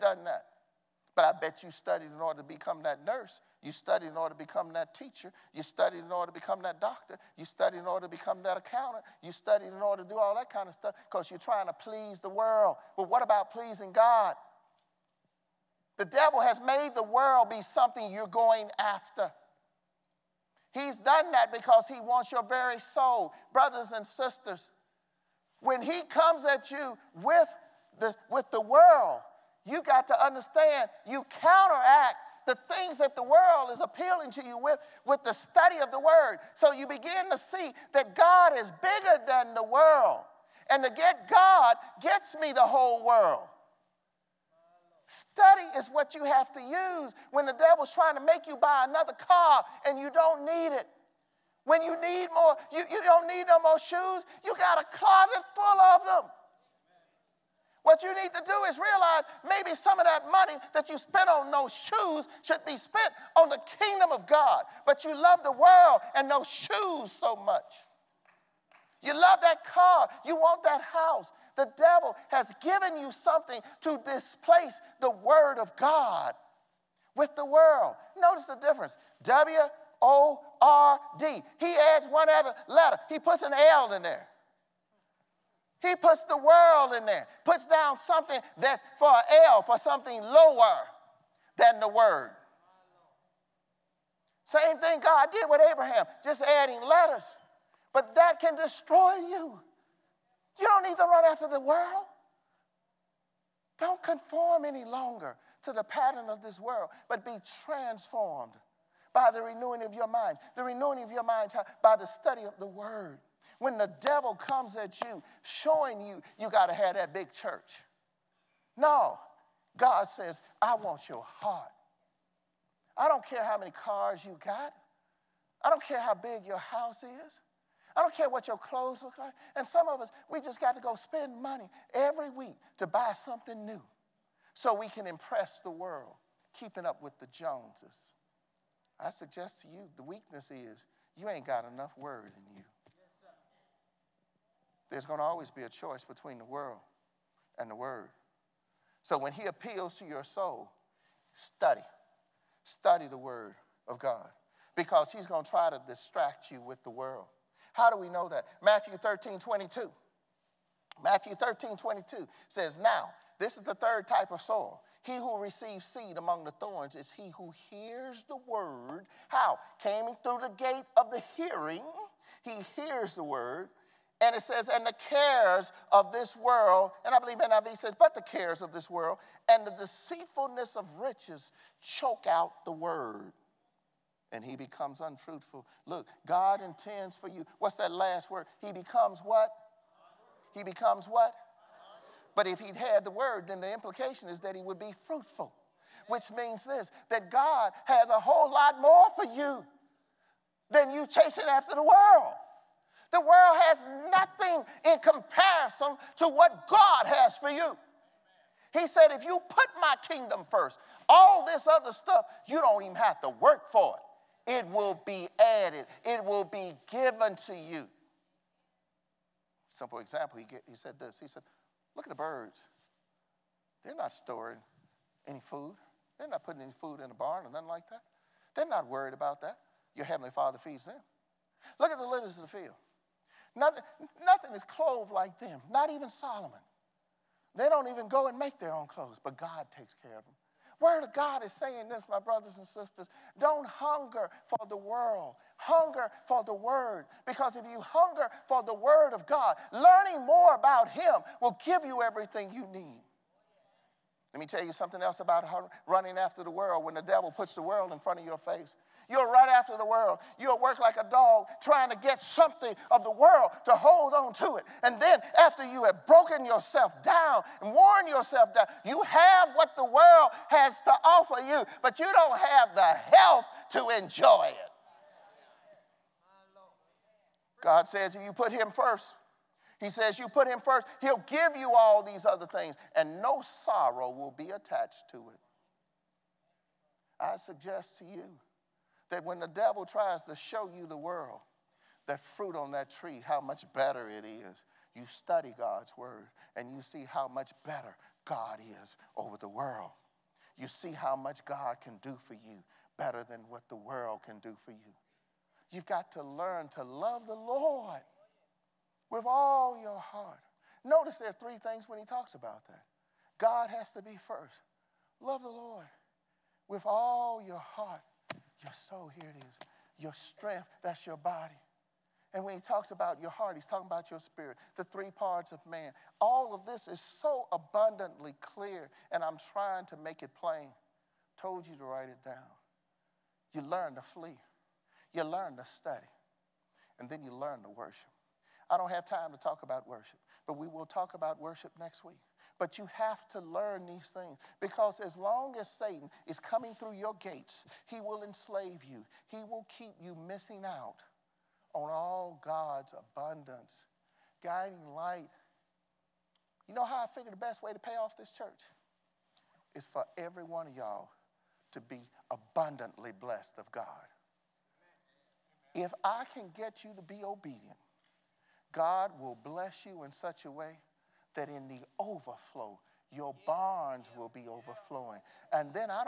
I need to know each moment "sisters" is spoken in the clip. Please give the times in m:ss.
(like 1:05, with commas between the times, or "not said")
0:24, 4:02.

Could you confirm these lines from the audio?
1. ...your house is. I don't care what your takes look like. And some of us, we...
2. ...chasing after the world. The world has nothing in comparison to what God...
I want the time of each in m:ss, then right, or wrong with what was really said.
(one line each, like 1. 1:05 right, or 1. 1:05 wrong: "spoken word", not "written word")
1. 2:06 wrong: "clothes", not "takes"
2. 3:21 right.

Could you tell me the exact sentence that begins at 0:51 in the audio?
When you need more, you, you don't need no more shoes, you got a closet full of them.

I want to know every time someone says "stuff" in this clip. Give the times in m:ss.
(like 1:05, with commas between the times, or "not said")
0:10, 3:31.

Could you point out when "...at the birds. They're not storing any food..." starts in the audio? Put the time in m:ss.
3:42.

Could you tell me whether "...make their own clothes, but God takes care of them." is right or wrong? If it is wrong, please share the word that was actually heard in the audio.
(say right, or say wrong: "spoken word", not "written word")
right.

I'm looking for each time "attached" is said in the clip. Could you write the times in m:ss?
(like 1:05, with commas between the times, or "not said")
4:44.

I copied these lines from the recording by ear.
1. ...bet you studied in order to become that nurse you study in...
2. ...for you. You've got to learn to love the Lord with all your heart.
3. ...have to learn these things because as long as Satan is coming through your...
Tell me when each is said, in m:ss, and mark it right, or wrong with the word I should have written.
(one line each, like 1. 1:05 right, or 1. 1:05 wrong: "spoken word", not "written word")
1. 0:01 right
2. 5:04 right
3. 5:42 right.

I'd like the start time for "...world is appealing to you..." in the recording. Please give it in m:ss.
0:33.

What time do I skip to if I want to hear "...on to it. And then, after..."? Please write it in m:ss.
4:24.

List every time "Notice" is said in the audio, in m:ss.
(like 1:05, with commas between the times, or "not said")
1:18, 5:10.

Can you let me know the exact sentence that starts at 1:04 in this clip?
But you love the world and those shoes so much.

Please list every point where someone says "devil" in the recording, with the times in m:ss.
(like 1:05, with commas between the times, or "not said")
0:16, 0:47, 1:11, 1:54, 4:17, 4:49.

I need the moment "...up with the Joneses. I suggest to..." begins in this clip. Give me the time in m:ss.
2:16.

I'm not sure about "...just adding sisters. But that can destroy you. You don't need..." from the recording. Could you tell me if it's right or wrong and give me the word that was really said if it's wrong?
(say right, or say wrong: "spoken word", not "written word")
wrong: "letters", not "sisters".